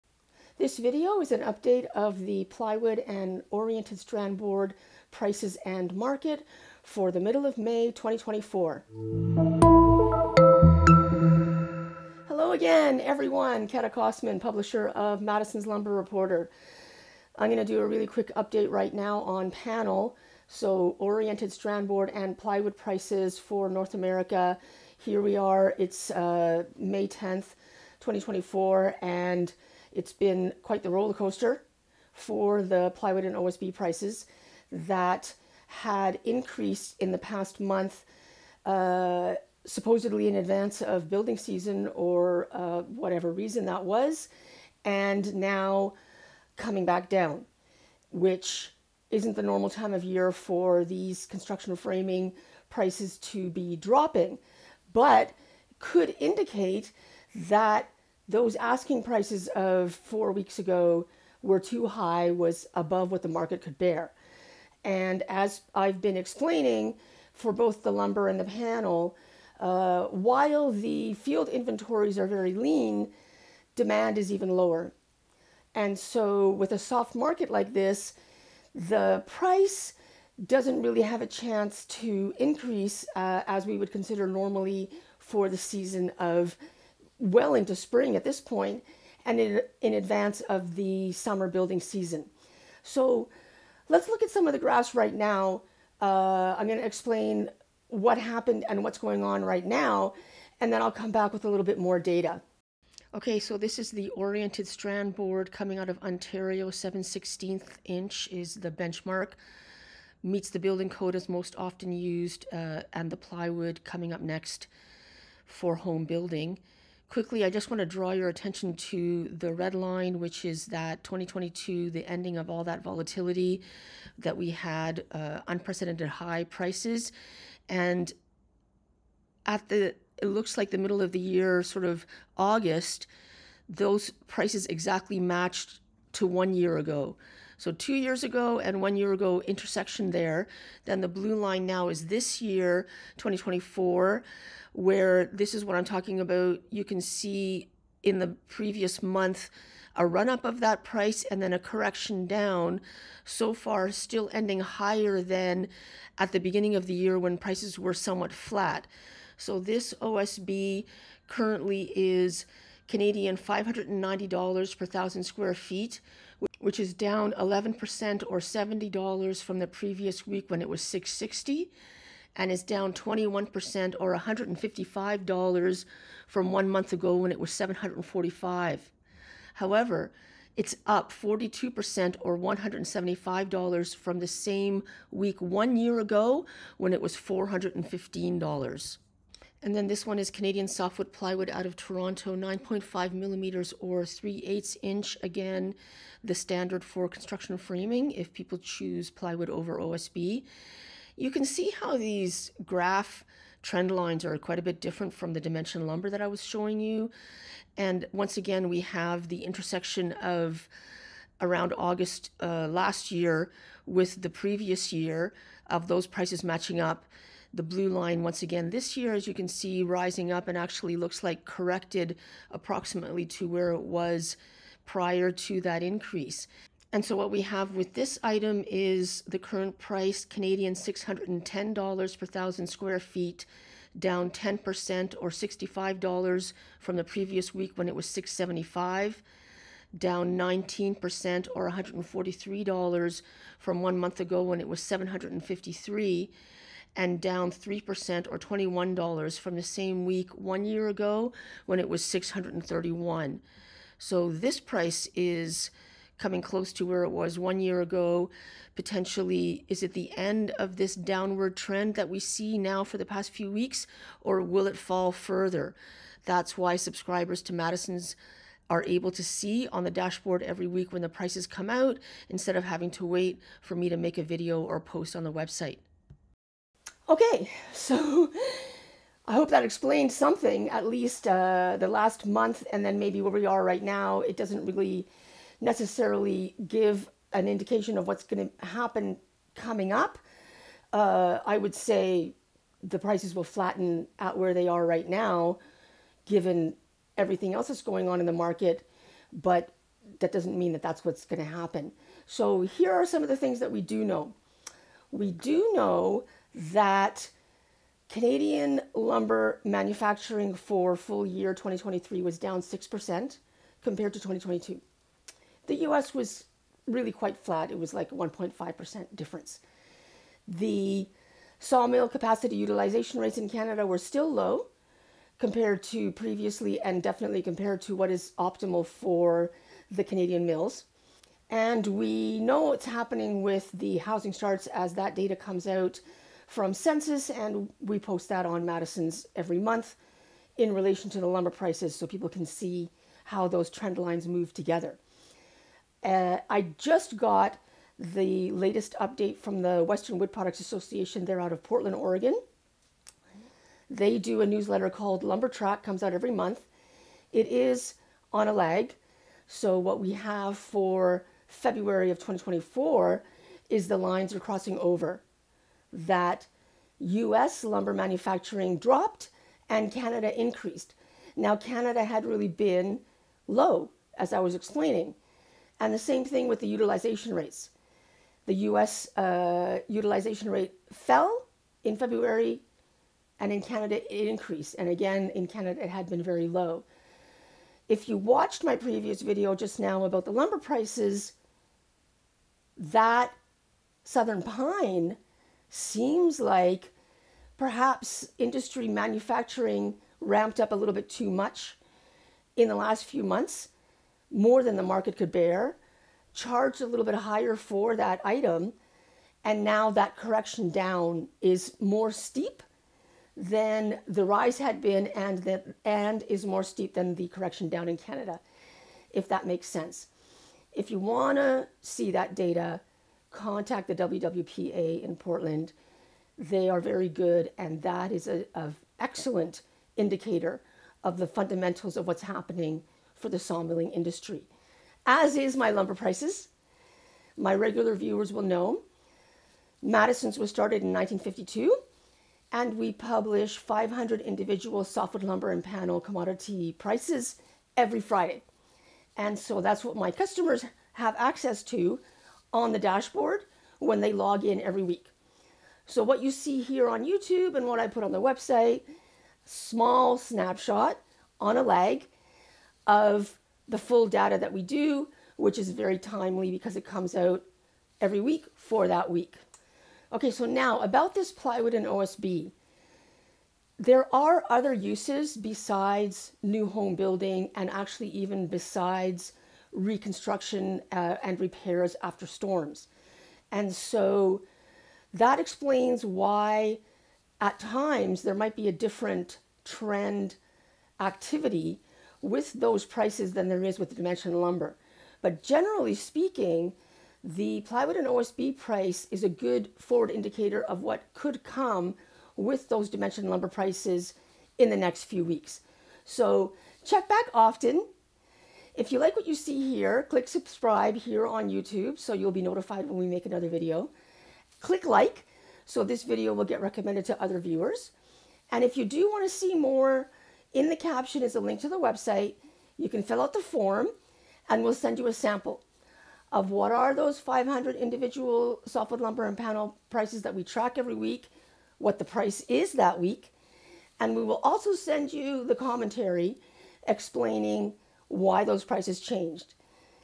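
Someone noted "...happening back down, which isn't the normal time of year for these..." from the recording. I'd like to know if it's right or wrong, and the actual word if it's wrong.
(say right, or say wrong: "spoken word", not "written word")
wrong: "coming", not "happening".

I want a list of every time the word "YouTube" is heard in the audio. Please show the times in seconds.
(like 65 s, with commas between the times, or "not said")
457 s, 511 s.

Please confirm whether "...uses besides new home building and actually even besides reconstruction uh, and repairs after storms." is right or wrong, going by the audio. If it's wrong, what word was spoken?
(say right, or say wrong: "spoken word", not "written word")
right.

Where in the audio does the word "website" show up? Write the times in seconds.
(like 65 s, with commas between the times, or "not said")
275 s, 458 s, 521 s.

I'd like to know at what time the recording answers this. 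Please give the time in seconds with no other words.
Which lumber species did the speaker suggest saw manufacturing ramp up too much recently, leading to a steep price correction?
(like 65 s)
394 s.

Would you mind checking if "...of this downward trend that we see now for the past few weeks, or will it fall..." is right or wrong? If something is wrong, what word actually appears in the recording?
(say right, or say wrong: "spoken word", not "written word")
right.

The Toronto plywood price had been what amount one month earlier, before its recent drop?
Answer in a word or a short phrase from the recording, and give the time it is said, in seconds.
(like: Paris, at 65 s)
753, at 244 s.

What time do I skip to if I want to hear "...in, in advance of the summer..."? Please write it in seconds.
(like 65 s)
89 s.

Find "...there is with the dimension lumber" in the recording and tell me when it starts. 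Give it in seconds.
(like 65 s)
493 s.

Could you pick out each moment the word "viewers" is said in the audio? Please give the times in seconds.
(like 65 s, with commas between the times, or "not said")
437 s, 517 s.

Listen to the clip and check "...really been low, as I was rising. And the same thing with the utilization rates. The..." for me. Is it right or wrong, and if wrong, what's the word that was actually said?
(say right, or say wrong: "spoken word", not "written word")
wrong: "explaining", not "rising".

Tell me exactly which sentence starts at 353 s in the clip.
They do a newsletter called Lumber Track, comes out every month.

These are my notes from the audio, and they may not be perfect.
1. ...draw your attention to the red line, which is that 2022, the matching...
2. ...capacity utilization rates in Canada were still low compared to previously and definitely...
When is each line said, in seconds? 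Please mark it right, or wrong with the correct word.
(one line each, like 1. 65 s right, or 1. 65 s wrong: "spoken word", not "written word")
1. 117 s wrong: "ending", not "matching"
2. 322 s right.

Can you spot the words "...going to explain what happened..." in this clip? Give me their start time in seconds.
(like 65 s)
96 s.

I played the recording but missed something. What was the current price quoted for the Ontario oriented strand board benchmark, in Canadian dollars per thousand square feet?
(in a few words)
$590.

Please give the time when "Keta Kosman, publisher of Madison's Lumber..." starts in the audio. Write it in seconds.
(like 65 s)
13 s.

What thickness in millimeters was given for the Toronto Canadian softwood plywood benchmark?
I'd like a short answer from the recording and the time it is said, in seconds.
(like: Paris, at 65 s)
9.5 millimeters, at 192 s.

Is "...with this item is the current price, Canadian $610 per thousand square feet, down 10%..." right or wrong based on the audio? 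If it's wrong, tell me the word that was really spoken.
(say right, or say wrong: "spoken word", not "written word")
right.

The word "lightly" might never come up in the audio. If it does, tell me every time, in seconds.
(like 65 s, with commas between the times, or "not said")
not said.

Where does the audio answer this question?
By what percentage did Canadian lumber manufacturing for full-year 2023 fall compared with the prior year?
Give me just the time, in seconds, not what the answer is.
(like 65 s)
312 s.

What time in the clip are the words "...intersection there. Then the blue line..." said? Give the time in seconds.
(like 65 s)
139 s.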